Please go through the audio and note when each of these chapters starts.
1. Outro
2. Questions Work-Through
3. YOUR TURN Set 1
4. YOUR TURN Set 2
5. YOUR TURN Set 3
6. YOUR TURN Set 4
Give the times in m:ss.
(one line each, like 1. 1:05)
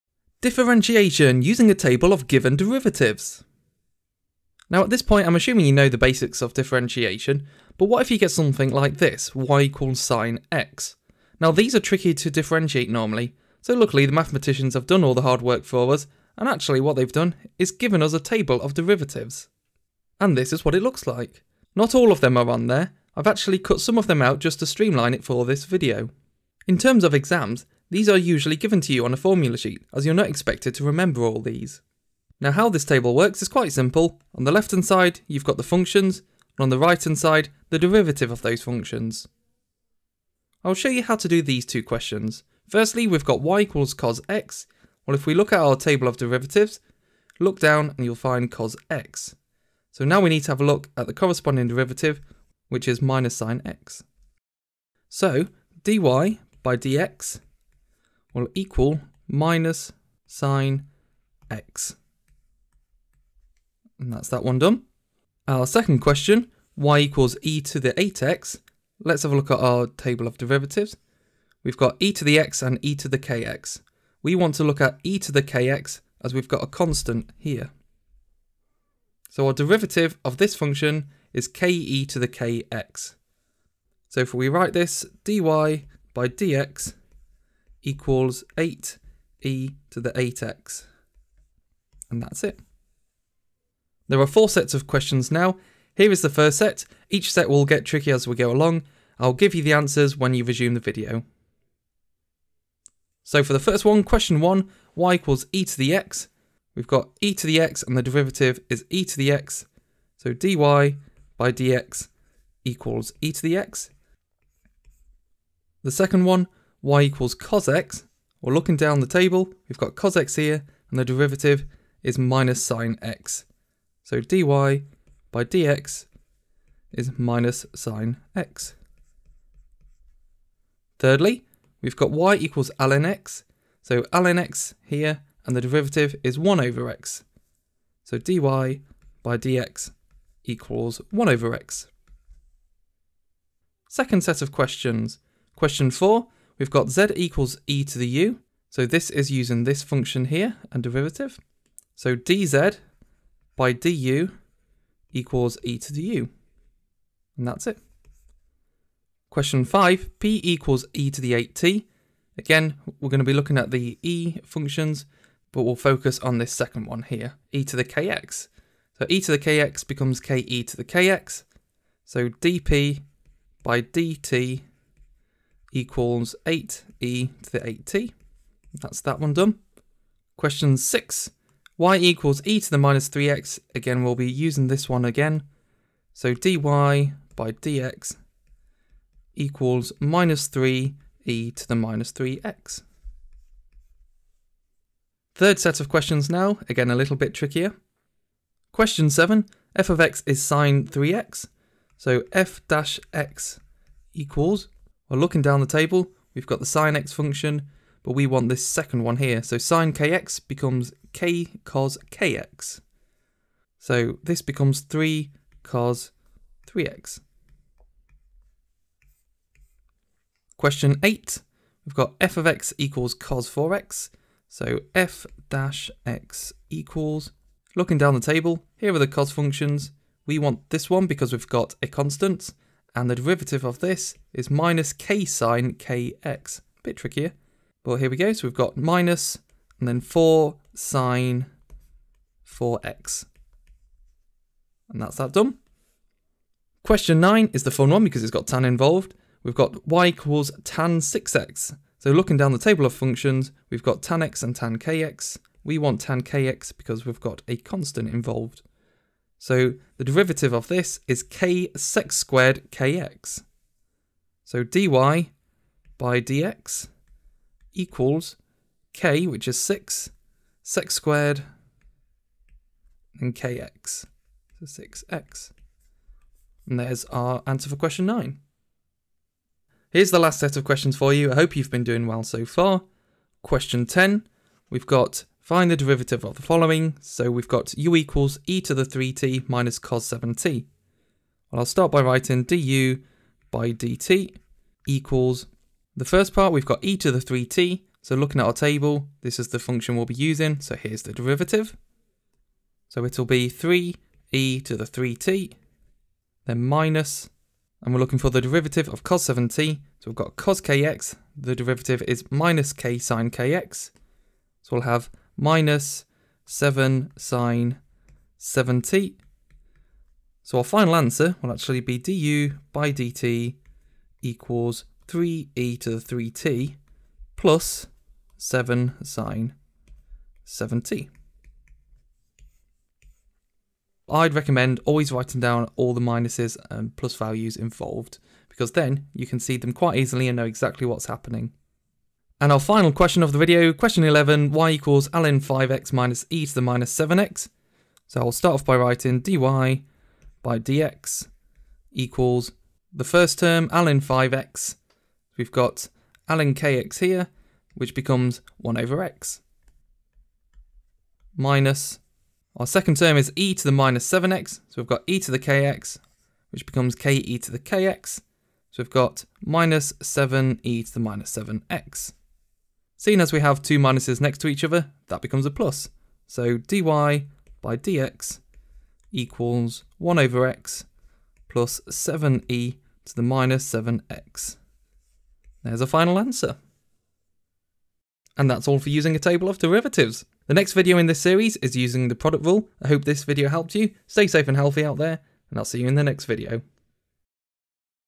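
1. 6:28
2. 0:40
3. 1:33
4. 2:23
5. 3:14
6. 4:39.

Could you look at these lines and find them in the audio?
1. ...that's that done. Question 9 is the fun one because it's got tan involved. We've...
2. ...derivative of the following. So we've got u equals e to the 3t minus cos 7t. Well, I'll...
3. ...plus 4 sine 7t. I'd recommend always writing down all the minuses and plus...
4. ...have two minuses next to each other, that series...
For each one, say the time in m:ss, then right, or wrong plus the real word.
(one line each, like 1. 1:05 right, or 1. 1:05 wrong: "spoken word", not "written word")
1. 4:05 right
2. 4:45 right
3. 5:27 wrong: "7", not "4"
4. 6:13 wrong: "becomes", not "series".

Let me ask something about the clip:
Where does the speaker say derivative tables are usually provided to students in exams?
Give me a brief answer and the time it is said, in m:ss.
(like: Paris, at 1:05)
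On a formula sheet, at 0:29.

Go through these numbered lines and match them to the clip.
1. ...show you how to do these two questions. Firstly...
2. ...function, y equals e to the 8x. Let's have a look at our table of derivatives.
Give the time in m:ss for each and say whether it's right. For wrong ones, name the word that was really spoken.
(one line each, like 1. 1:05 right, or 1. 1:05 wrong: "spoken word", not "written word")
1. 0:40 right
2. 1:05 wrong: "question", not "function".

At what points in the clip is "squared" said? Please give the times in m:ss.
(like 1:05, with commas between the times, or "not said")
4:22, 4:30.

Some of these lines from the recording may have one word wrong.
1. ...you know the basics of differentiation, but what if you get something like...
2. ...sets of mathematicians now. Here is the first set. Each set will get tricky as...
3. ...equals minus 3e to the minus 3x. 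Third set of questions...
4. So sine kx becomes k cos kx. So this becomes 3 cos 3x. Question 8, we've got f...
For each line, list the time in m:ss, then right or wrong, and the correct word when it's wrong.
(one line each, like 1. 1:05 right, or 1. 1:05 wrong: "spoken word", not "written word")
1. 0:05 right
2. 1:34 wrong: "questions", not "mathematicians"
3. 3:09 right
4. 3:29 right.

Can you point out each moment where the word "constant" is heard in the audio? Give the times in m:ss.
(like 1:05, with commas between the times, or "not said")
1:16, 3:51, 4:17.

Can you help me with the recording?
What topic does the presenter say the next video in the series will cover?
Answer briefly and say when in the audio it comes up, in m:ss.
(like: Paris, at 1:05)
The product rule, at 6:32.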